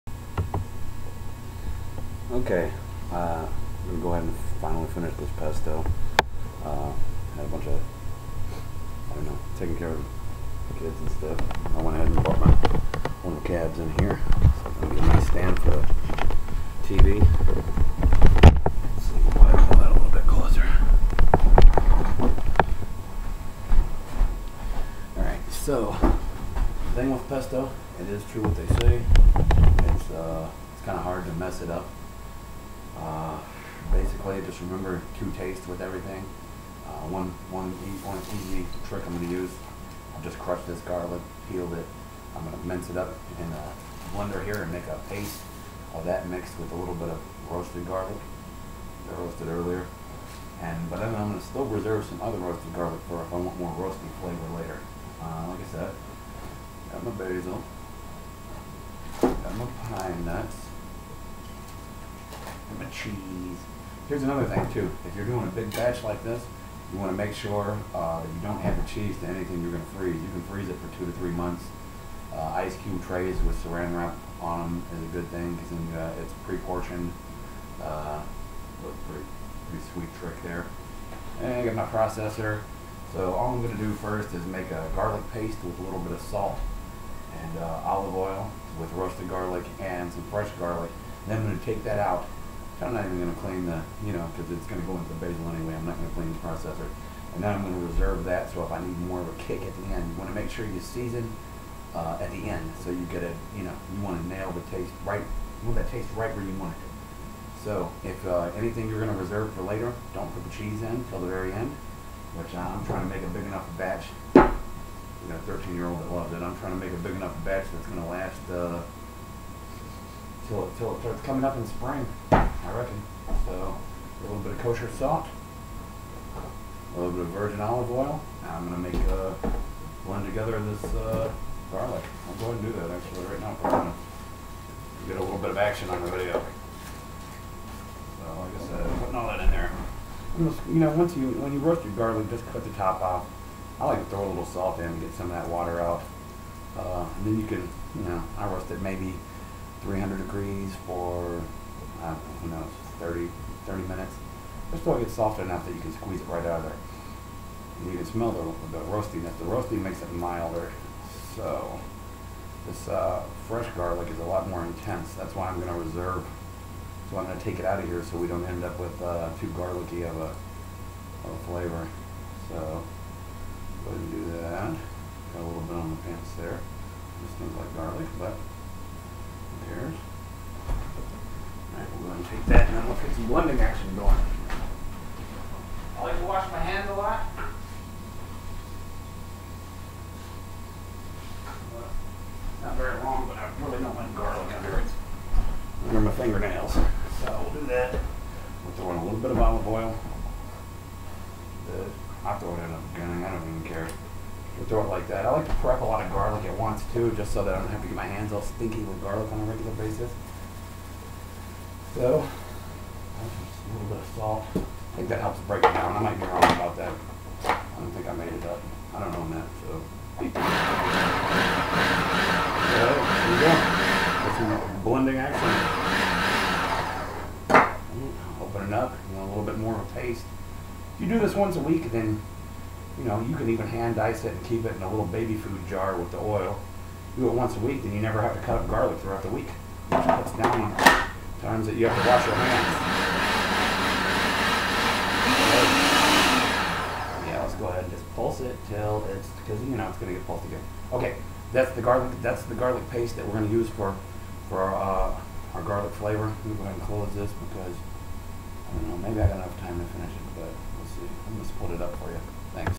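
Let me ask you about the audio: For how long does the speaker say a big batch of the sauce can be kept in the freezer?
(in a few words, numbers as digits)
2 to 3 months.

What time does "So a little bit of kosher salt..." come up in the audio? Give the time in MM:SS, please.
02:03.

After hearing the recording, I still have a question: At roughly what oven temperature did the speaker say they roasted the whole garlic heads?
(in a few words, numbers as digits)
300 degrees.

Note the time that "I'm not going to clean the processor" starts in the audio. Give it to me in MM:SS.
01:35.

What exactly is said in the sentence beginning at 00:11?
I went ahead and brought my one of the cabs in here.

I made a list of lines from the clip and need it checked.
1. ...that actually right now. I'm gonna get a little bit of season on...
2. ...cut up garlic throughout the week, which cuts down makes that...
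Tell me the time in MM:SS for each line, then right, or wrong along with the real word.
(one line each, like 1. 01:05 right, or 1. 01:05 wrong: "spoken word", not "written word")
1. 02:12 wrong: "action", not "season"
2. 03:58 wrong: "times", not "makes".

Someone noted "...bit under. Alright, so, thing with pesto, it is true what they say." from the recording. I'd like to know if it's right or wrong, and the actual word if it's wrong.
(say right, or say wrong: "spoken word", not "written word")
wrong: "closer", not "under".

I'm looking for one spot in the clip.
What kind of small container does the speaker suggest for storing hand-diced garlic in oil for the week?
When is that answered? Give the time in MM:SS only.
03:55.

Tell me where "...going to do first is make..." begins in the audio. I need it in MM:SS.
01:23.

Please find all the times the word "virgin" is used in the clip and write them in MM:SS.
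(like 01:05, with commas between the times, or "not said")
02:07.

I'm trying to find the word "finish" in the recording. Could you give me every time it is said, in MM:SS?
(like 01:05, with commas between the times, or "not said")
00:04, 04:19.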